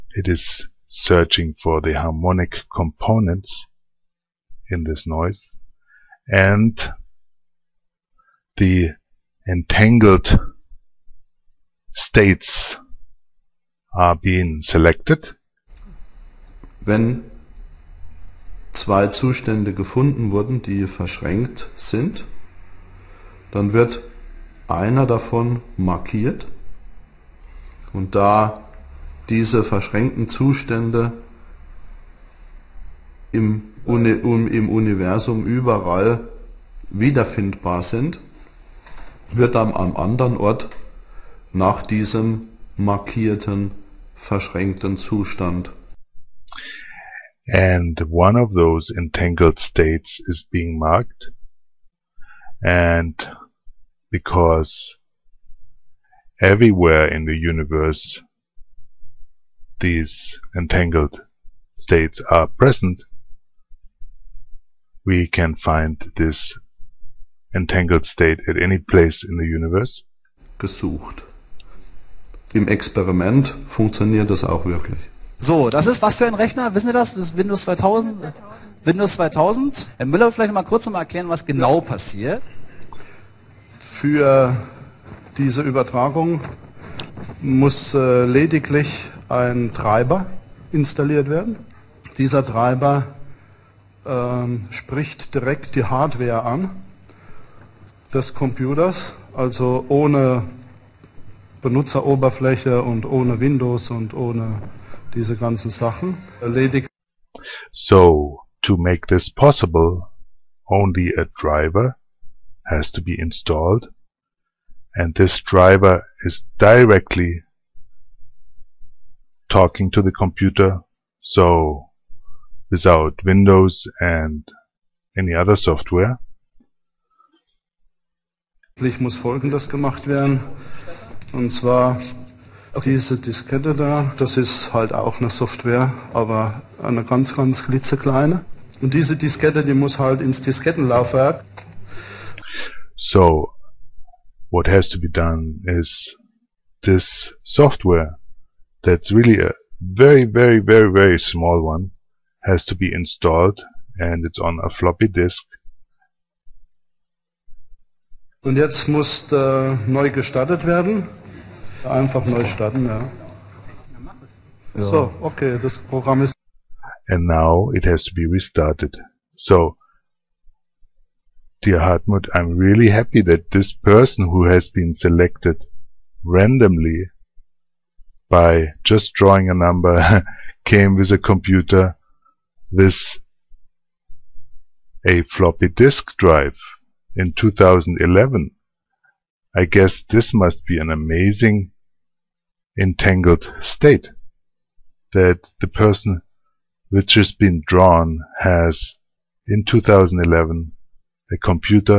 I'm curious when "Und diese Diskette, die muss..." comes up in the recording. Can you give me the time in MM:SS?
02:18.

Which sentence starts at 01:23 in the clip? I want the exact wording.
Für diese Übertragung muss äh, lediglich ein Treiber installiert werden.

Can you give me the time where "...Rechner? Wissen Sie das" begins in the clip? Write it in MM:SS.
01:16.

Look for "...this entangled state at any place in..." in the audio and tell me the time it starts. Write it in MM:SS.
01:06.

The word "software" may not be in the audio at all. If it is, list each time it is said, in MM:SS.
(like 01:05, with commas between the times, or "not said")
02:05, 02:15, 02:27.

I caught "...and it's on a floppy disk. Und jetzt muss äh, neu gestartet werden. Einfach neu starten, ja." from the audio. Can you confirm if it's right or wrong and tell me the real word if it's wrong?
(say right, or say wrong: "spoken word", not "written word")
right.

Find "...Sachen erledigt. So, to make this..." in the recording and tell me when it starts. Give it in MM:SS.
01:45.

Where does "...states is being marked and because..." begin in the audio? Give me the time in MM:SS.
00:49.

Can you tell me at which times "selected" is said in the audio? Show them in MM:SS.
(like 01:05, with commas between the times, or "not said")
00:14, 02:54.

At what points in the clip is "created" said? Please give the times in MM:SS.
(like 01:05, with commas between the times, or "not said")
not said.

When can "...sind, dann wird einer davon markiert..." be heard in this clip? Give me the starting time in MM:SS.
00:21.